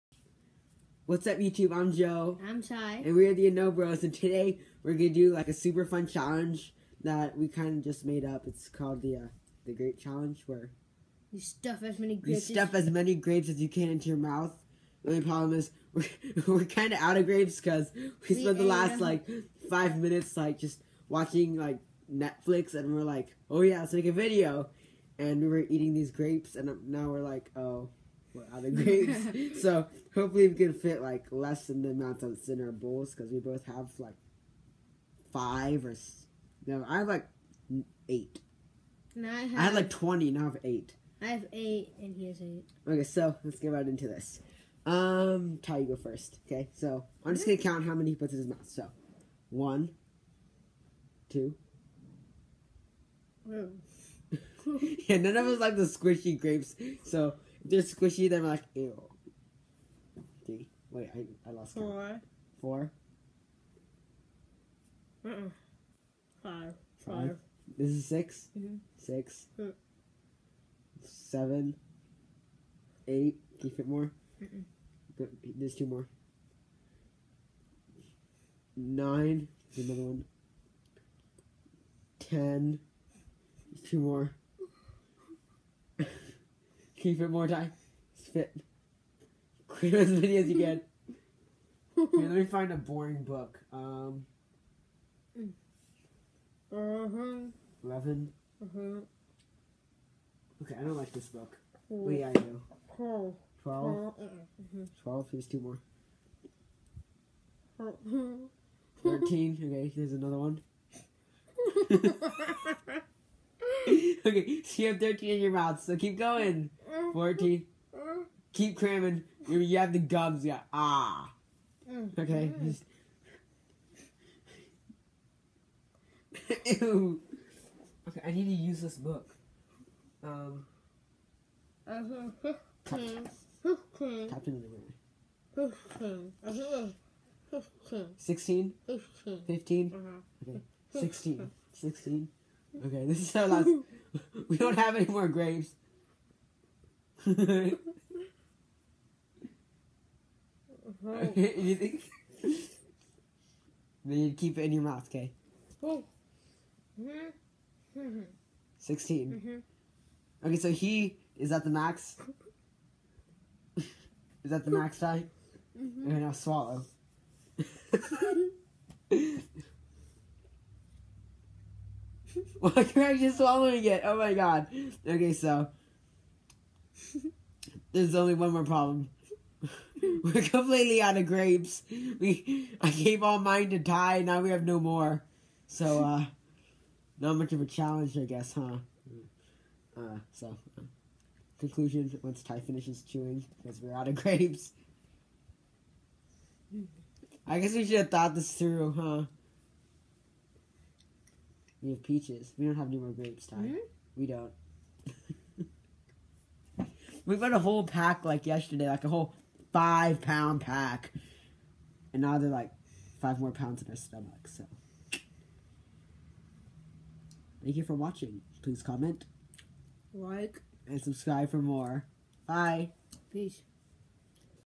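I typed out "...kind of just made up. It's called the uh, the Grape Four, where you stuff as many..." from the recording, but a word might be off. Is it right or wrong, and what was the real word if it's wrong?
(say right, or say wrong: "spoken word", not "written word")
wrong: "Challenge", not "Four".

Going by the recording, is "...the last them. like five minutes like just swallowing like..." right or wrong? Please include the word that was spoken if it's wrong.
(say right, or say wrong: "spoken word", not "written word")
wrong: "watching", not "swallowing".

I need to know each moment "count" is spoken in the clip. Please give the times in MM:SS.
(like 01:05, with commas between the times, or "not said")
00:47, 01:02.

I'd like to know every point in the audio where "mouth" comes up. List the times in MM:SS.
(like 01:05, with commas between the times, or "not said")
00:14, 00:48, 01:55, 02:34.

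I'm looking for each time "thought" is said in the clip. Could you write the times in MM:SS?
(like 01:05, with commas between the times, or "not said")
03:18.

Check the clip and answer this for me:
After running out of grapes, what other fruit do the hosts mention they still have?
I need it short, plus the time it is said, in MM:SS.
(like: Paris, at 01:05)
Peaches, at 03:22.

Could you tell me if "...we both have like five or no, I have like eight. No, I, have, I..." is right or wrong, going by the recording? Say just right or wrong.
right.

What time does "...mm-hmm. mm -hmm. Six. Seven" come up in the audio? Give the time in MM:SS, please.
01:08.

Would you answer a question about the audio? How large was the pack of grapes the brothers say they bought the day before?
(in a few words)
5 pounds.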